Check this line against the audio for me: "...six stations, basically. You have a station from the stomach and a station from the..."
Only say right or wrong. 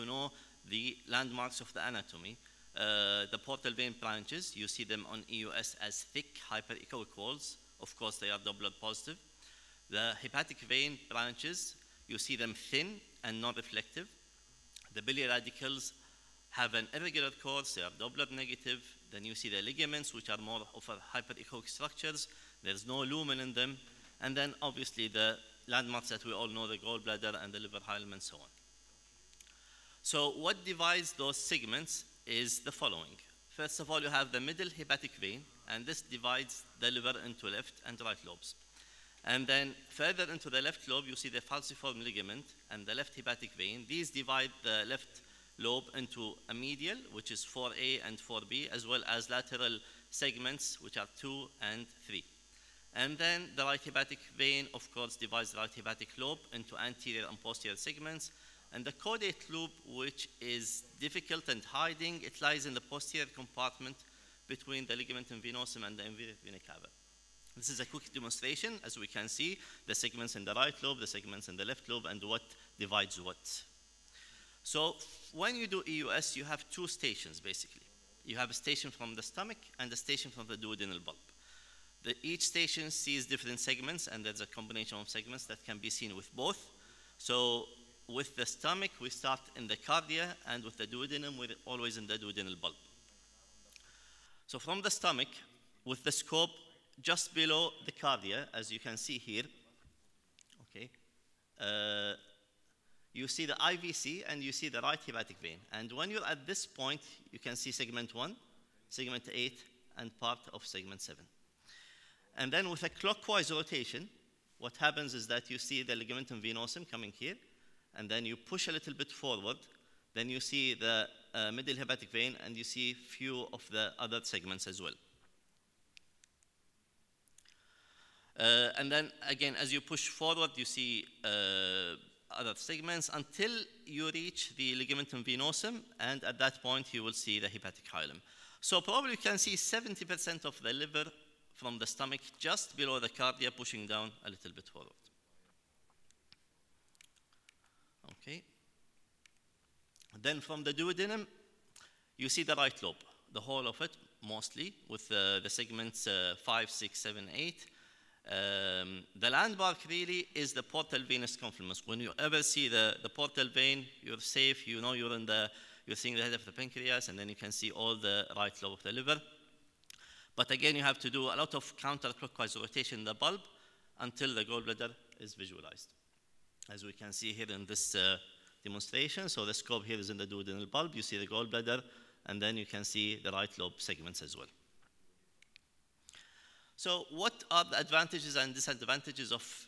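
wrong.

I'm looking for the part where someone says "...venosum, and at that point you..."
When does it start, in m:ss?
2:15.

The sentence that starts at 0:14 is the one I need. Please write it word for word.
The biliary radicals have an irregular course, they are Doppler negative.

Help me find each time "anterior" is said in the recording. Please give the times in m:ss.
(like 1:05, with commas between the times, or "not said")
0:56.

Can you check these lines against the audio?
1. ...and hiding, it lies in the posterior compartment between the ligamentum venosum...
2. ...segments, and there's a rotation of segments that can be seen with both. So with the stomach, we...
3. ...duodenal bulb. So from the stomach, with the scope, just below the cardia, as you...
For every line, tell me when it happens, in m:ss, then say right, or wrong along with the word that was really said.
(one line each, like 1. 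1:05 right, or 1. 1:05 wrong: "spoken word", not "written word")
1. 1:01 right
2. 1:23 wrong: "combination", not "rotation"
3. 1:32 right.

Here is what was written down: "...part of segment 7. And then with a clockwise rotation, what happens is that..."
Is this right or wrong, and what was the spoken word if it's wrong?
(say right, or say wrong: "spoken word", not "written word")
right.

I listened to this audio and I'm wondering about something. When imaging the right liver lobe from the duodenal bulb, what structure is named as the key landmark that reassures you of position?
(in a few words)
Portal venous confluence.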